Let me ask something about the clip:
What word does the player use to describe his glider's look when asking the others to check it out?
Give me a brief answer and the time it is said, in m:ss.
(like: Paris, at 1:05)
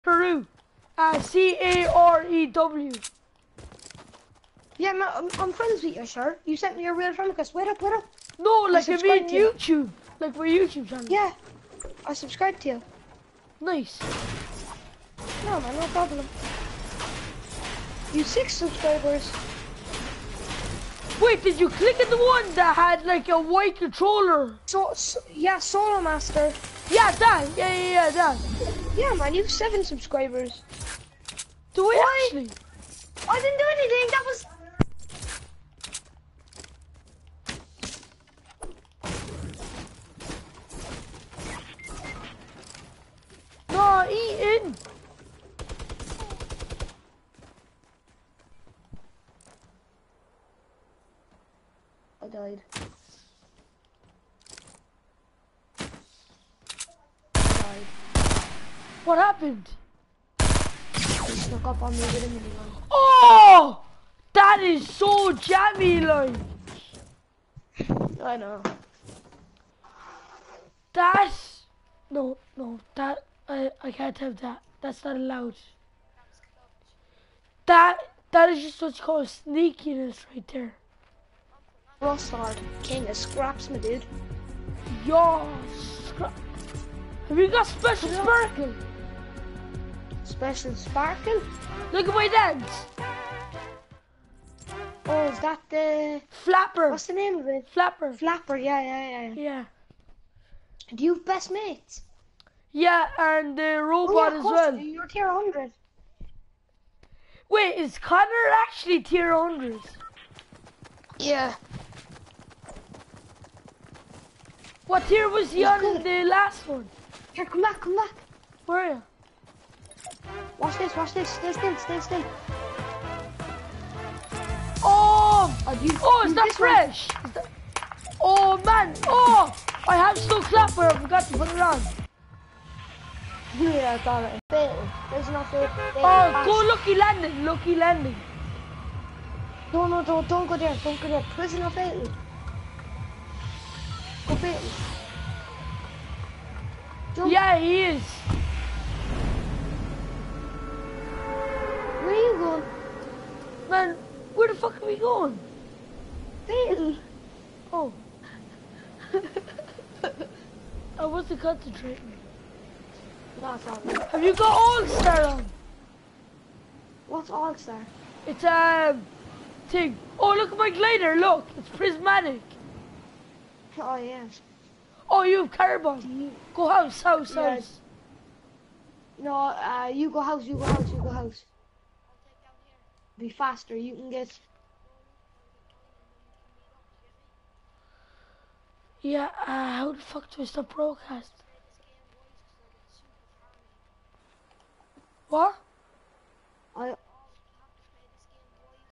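Prismatic, at 2:51.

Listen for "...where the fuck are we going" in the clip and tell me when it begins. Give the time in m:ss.
2:34.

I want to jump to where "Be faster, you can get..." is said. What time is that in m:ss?
3:03.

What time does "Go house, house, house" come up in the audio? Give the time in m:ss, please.
2:56.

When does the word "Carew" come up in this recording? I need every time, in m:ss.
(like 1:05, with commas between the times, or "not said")
0:00.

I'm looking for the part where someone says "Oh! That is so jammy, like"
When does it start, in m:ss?
1:02.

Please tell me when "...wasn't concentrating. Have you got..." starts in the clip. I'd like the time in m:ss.
2:41.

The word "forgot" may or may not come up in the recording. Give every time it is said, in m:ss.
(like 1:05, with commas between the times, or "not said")
2:10.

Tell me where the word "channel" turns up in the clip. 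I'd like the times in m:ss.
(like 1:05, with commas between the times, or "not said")
0:10.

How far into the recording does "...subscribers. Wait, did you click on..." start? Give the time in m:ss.
0:18.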